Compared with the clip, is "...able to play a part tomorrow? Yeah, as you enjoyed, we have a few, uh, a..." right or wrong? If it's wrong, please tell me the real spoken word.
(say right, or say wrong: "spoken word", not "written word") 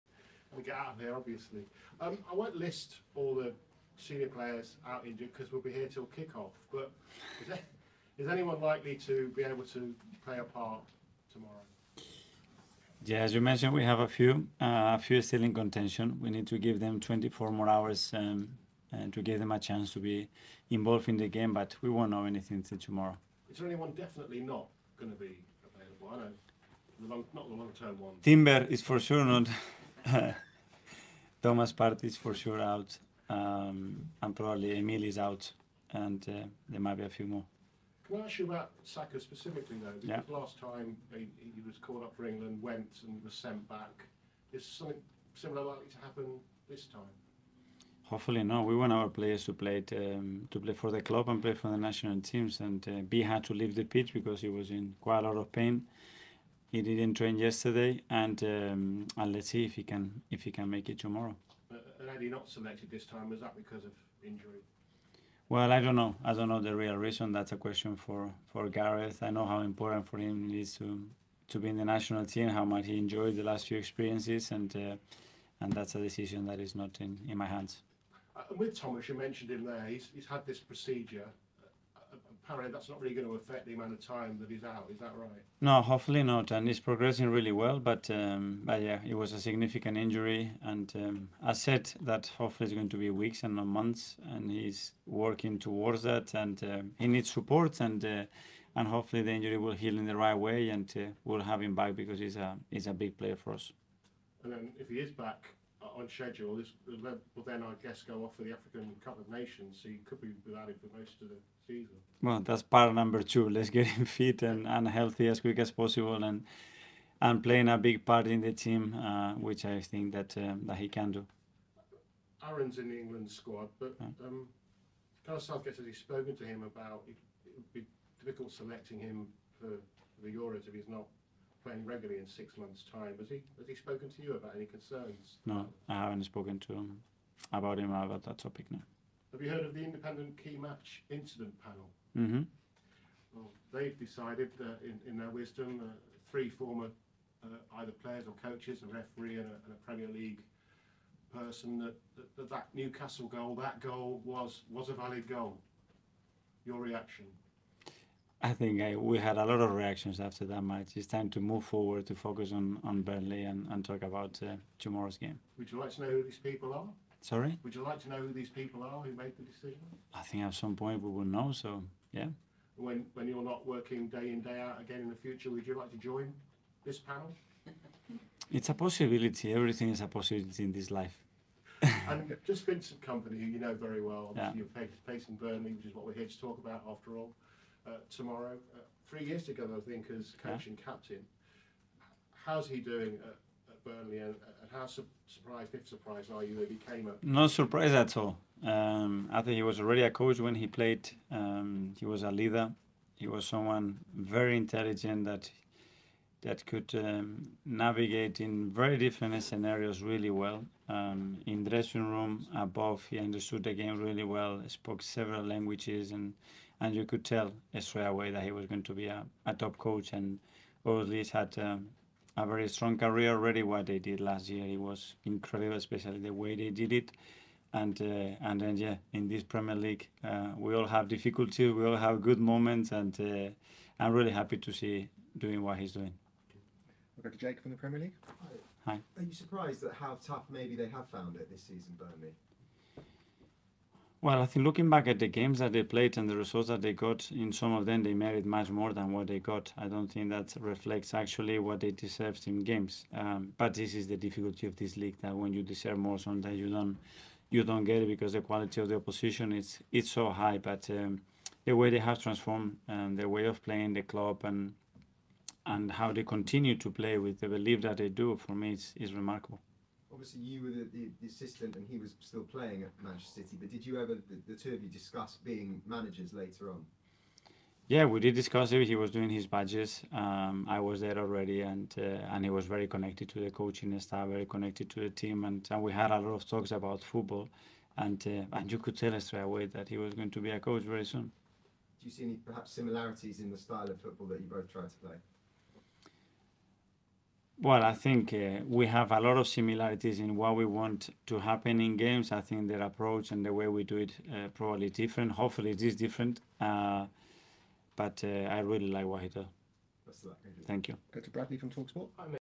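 wrong: "mentioned", not "enjoyed".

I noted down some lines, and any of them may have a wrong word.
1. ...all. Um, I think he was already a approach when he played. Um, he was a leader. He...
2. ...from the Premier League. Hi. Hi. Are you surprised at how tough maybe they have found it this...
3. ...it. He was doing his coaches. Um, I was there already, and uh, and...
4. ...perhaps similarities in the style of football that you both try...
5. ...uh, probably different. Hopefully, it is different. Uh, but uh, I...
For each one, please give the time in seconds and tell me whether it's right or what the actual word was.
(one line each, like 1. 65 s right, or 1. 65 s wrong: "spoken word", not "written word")
1. 198 s wrong: "coach", not "approach"
2. 237 s right
3. 278 s wrong: "badges", not "coaches"
4. 292 s right
5. 304 s right.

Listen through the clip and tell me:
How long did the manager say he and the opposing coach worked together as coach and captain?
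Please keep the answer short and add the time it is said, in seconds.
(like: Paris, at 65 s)
Three years, at 189 s.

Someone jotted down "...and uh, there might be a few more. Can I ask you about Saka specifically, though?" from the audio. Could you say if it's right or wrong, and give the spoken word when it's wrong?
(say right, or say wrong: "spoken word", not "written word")
right.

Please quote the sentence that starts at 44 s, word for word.
Is something similar likely to happen this time?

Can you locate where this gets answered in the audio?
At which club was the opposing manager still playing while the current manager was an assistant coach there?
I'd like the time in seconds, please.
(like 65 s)
273 s.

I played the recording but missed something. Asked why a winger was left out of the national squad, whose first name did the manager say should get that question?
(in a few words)
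Gareth.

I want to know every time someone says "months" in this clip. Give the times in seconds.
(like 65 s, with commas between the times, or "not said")
93 s, 132 s.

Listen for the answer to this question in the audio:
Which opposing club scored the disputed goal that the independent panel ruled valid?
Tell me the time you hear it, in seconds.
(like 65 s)
152 s.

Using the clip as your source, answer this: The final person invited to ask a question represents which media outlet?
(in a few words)
Talksport.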